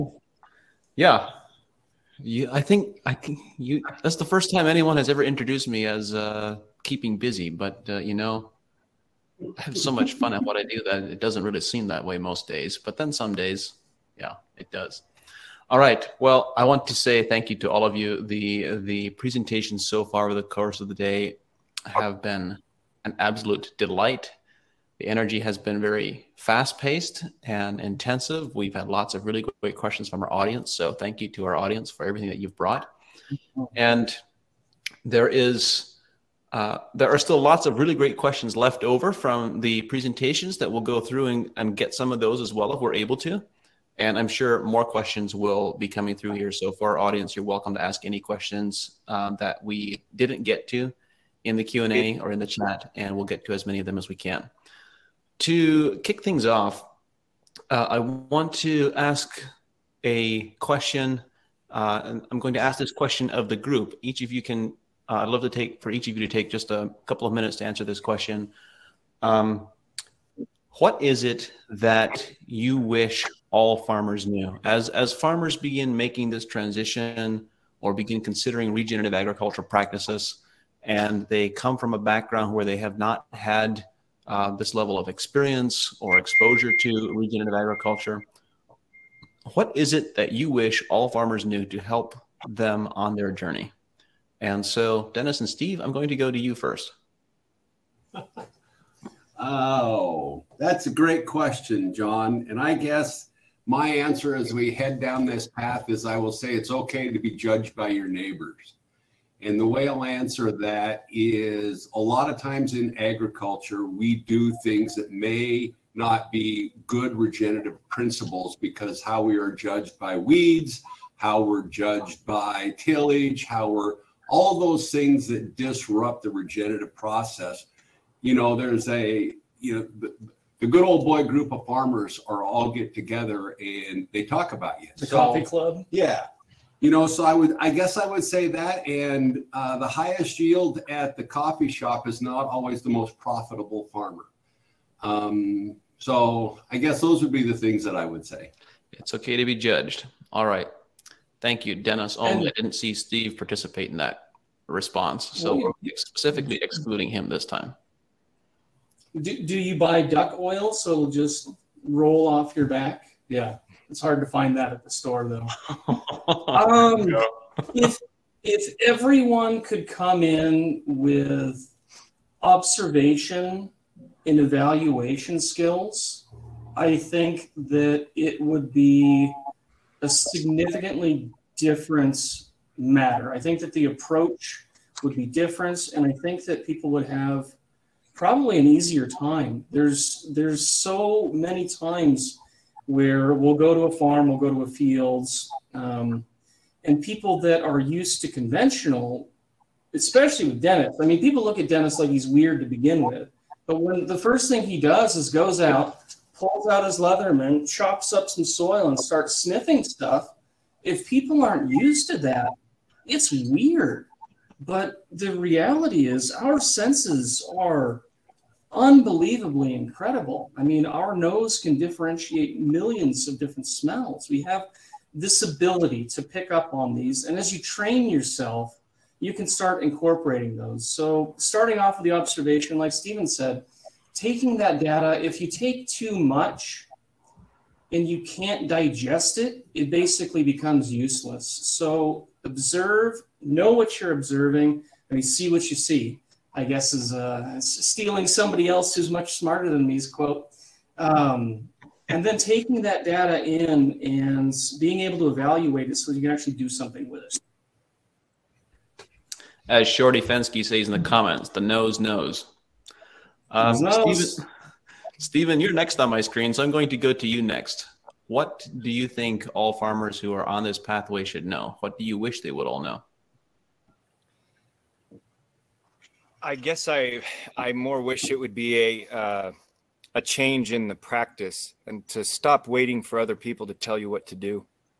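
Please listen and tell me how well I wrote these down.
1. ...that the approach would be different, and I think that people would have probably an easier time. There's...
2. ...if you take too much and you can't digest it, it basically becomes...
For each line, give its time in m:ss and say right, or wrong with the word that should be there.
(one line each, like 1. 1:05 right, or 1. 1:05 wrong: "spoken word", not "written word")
1. 3:03 right
2. 3:55 right.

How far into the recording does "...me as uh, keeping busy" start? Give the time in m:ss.
0:05.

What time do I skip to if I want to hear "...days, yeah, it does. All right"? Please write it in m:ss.
0:13.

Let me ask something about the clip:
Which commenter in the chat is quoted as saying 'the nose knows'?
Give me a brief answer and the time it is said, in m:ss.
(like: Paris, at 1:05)
Shorty Fensky, at 4:19.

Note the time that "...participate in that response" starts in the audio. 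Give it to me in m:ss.
2:33.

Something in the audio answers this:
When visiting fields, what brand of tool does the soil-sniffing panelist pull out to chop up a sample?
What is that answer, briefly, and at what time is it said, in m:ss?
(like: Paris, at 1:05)
Leatherman, at 3:26.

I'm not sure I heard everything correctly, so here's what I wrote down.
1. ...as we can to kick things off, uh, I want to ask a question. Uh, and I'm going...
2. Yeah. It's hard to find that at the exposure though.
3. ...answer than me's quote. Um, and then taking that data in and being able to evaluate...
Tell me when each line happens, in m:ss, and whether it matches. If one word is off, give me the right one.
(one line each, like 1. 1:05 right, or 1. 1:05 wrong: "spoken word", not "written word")
1. 0:53 right
2. 2:43 wrong: "store", not "exposure"
3. 4:09 wrong: "smarter", not "answer".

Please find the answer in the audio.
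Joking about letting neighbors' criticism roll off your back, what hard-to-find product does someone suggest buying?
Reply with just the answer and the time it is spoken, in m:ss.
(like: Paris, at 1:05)
Duck oil, at 2:40.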